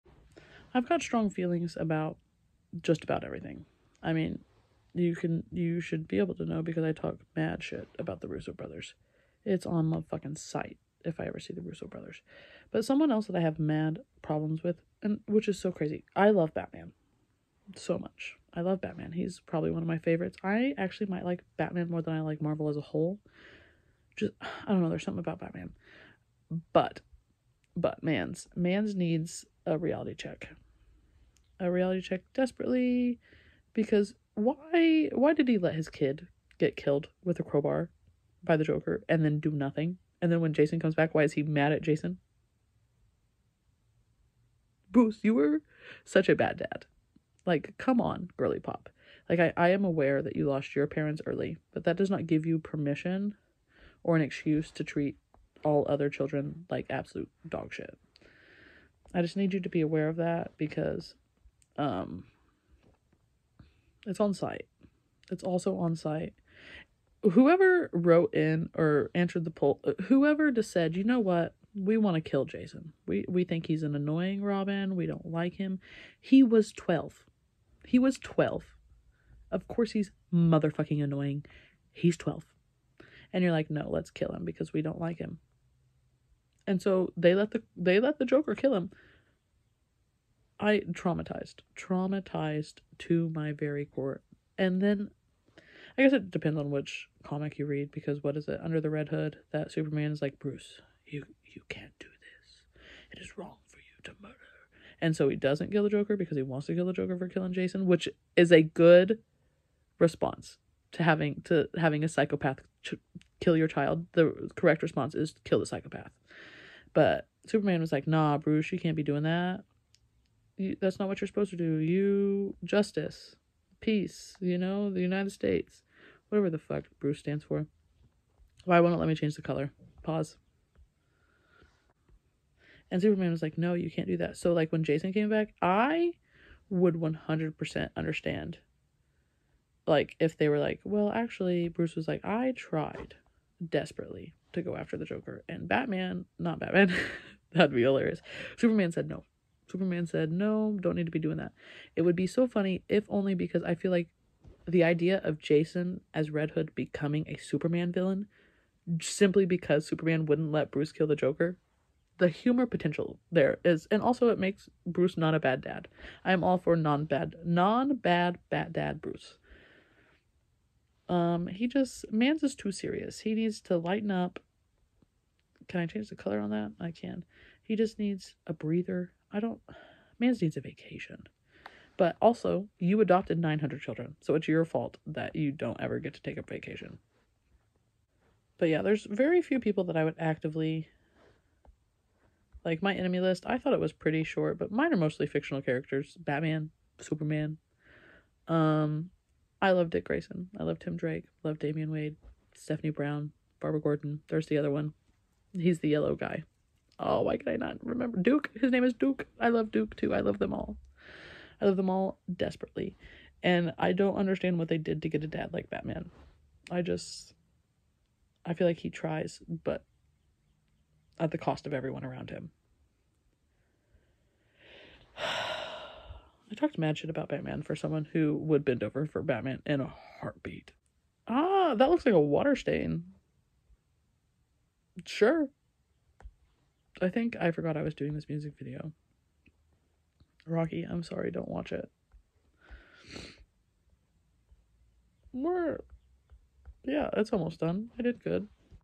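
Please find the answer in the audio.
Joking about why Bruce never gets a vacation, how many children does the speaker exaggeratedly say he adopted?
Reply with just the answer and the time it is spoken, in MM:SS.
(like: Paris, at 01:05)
900, at 03:03.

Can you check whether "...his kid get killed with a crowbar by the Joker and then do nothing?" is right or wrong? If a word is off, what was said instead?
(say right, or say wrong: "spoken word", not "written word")
right.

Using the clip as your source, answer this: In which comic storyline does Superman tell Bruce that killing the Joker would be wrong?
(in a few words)
Under the Red Hood.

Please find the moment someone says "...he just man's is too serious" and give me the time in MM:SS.
02:51.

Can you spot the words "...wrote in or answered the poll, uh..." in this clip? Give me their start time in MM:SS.
01:07.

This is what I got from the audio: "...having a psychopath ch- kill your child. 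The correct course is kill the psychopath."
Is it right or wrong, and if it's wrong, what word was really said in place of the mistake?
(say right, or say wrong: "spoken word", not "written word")
wrong: "response", not "course".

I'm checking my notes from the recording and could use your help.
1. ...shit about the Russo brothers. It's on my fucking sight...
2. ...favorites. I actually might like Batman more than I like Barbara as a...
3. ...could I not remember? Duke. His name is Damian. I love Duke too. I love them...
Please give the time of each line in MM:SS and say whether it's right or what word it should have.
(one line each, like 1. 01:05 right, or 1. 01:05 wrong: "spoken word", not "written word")
1. 00:07 right
2. 00:19 wrong: "Marvel", not "Barbara"
3. 03:27 wrong: "Duke", not "Damian".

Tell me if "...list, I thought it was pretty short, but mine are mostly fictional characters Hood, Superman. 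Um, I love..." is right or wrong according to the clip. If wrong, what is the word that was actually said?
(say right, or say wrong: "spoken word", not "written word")
wrong: "Batman", not "Hood".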